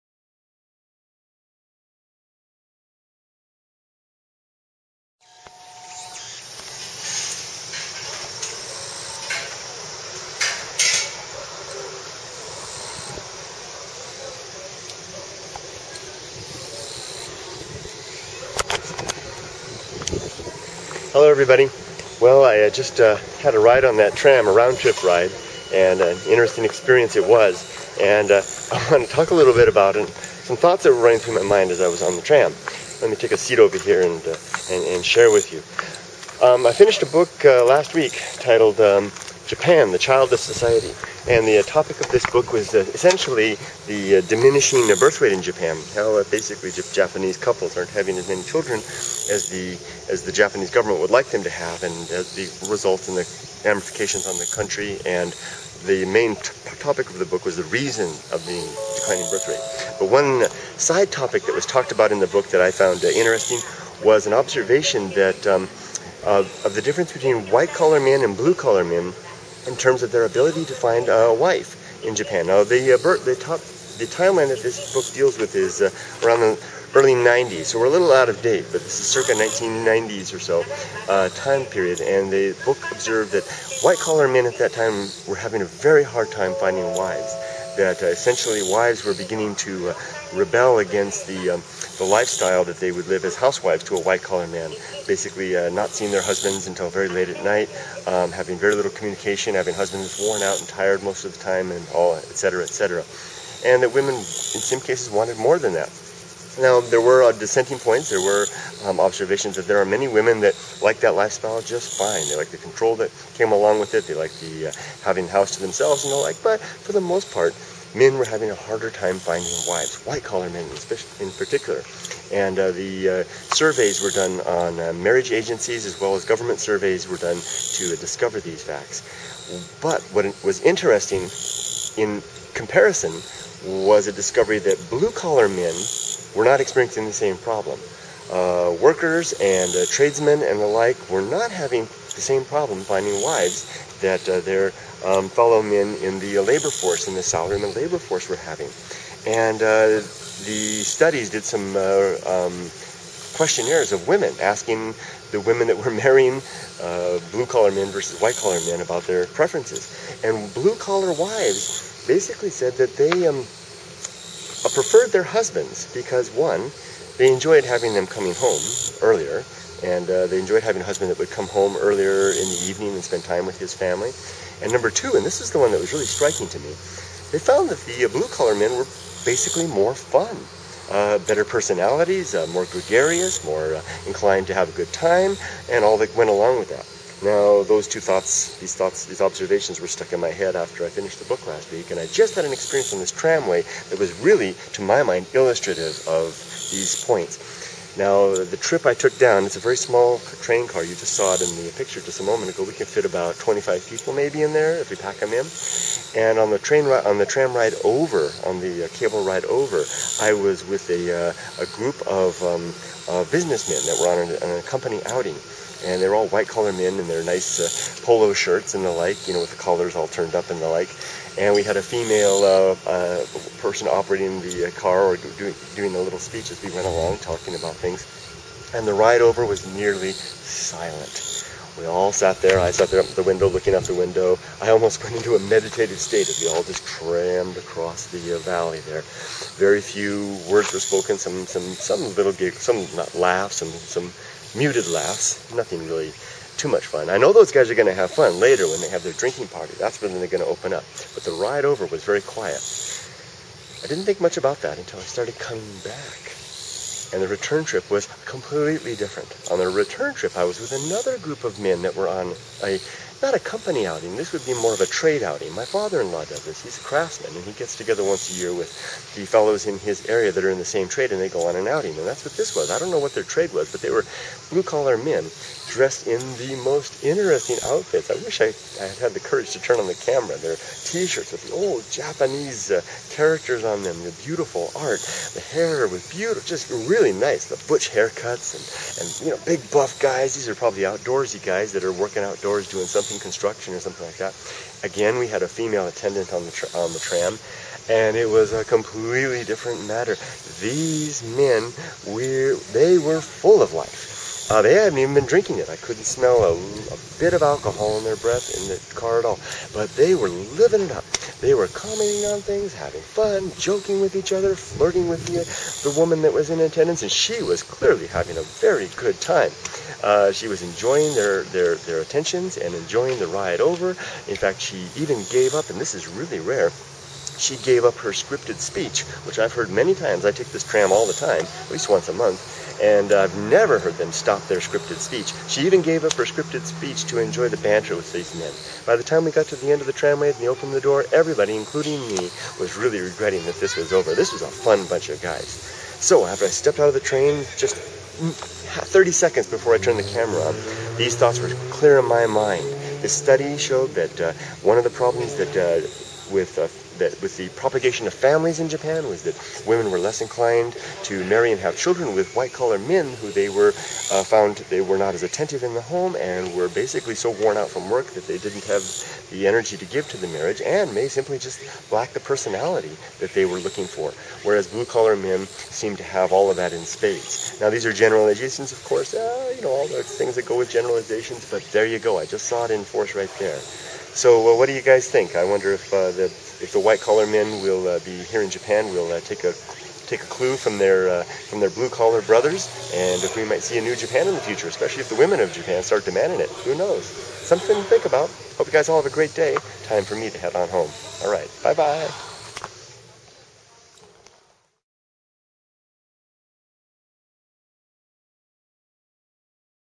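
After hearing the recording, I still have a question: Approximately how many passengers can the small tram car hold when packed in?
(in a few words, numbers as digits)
25.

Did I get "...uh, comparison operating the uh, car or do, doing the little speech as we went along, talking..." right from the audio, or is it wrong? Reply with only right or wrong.
wrong.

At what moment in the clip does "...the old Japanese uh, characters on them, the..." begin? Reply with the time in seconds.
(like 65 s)
281 s.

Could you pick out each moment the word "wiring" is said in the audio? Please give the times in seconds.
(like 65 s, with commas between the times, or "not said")
not said.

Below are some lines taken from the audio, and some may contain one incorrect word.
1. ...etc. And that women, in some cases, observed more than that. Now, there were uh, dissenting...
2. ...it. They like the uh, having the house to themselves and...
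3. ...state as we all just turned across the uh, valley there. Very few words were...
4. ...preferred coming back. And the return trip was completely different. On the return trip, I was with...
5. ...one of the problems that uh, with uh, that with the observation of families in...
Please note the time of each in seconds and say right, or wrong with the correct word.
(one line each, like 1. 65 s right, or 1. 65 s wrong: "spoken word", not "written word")
1. 102 s wrong: "wanted", not "observed"
2. 113 s right
3. 235 s wrong: "crammed", not "turned"
4. 255 s wrong: "started", not "preferred"
5. 354 s wrong: "propagation", not "observation".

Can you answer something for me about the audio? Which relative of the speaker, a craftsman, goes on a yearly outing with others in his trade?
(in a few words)
father-in-law.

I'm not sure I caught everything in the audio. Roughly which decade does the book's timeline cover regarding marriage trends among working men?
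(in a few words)
early 90s.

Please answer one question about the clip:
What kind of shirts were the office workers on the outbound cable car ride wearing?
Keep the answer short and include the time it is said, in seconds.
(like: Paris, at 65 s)
polo shirts, at 218 s.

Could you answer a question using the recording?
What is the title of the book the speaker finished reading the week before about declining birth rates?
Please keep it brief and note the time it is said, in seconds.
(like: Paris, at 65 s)
Japan, the Childless Society, at 39 s.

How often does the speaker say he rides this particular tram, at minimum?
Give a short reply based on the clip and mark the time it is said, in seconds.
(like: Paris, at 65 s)
once a month, at 331 s.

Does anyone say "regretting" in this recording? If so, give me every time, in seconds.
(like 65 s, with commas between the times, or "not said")
342 s.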